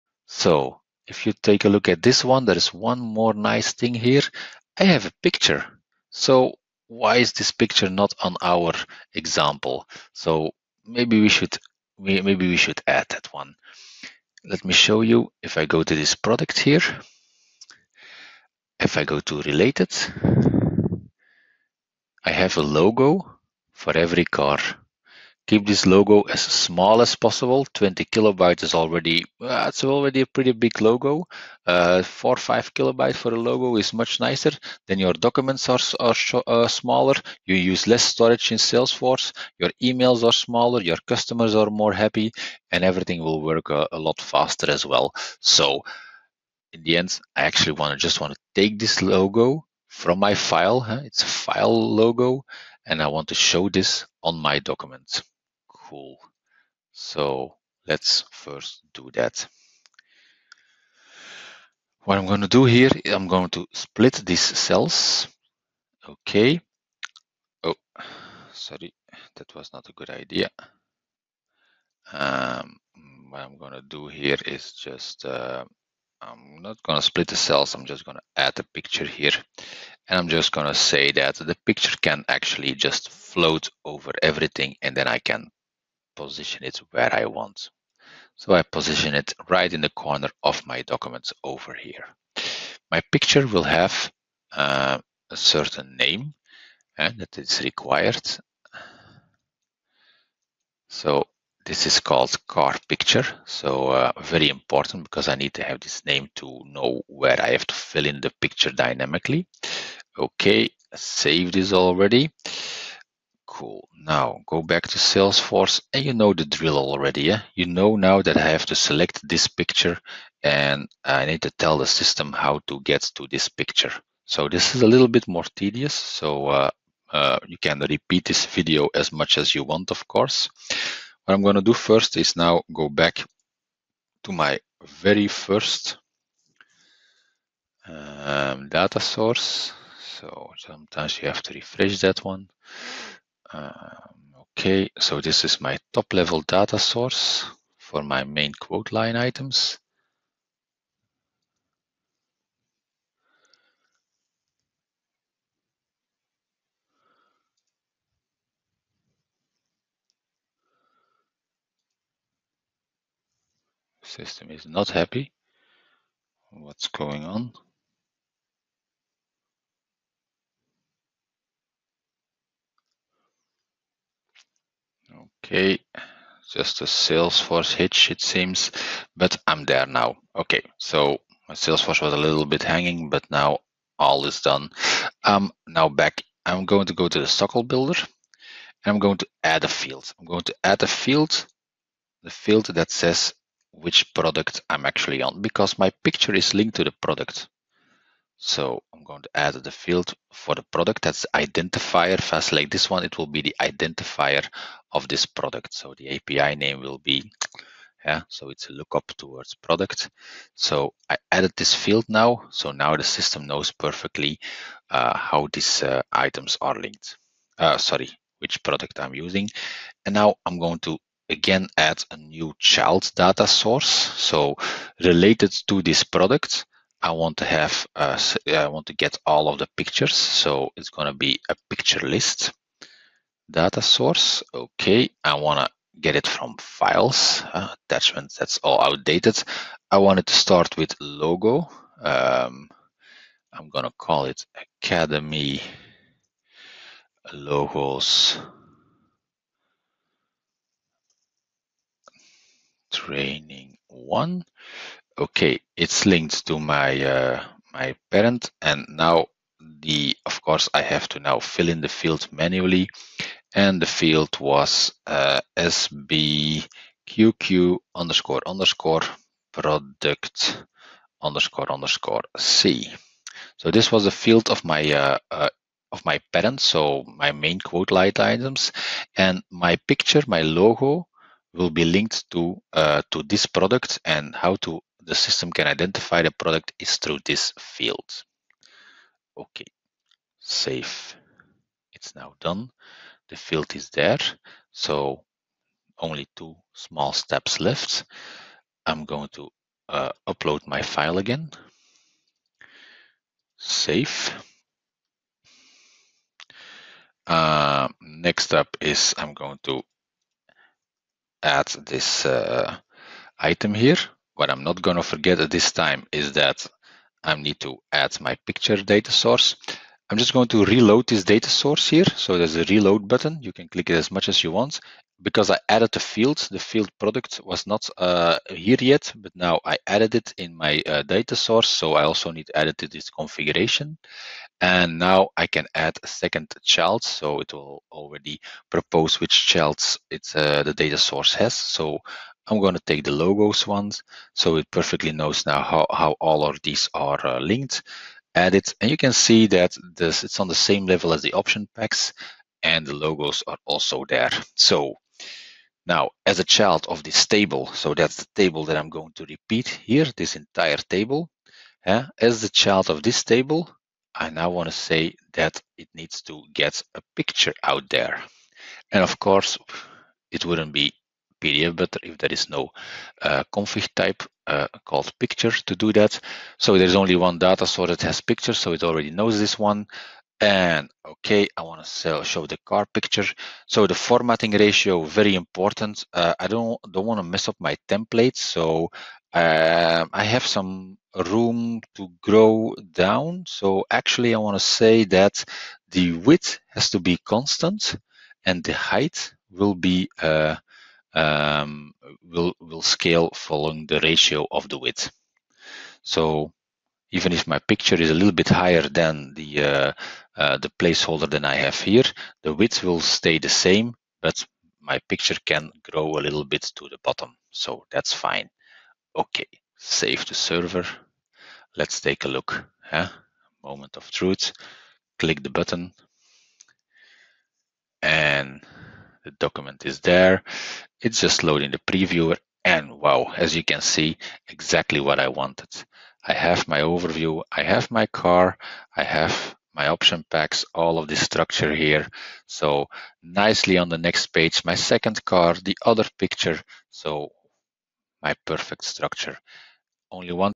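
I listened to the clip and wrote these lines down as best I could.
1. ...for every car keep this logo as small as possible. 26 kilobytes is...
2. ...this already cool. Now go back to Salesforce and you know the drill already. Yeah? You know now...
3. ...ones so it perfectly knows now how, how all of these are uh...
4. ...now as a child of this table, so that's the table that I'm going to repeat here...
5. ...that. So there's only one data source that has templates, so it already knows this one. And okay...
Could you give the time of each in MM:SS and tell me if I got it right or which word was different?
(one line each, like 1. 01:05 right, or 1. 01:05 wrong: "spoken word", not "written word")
1. 00:23 wrong: "20", not "26"
2. 01:51 right
3. 05:43 right
4. 05:55 right
5. 06:15 wrong: "pictures", not "templates".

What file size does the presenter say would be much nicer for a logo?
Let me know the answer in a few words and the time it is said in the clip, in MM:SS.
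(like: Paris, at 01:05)
4 to 5 kilobytes, at 00:32.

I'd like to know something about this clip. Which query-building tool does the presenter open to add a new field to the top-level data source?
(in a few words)
SOQL Builder.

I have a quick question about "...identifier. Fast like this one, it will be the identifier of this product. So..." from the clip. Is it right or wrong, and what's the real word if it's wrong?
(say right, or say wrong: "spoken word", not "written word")
right.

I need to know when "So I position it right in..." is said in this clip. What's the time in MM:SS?
01:28.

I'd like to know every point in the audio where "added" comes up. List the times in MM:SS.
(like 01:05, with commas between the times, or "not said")
03:31, 05:25, 05:29.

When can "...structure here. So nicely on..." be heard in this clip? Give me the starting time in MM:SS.
07:21.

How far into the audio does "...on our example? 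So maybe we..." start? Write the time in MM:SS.
00:08.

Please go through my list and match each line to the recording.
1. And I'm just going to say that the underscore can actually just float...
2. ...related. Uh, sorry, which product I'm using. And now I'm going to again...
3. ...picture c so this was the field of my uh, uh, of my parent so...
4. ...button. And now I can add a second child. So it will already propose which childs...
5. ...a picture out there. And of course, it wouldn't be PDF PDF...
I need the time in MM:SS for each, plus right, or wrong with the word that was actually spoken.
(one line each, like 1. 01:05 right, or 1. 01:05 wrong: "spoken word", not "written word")
1. 01:20 wrong: "picture", not "underscore"
2. 03:36 wrong: "linked", not "related"
3. 04:31 wrong: "underscore", not "picture"
4. 05:33 wrong: "configuration", not "button"
5. 06:06 wrong: "Butler", not "PDF".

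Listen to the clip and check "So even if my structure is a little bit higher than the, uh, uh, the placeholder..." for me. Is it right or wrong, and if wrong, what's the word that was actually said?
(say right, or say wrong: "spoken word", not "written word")
wrong: "picture", not "structure".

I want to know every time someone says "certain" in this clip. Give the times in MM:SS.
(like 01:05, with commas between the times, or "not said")
01:35.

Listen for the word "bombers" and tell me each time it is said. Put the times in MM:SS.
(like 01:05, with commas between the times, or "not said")
not said.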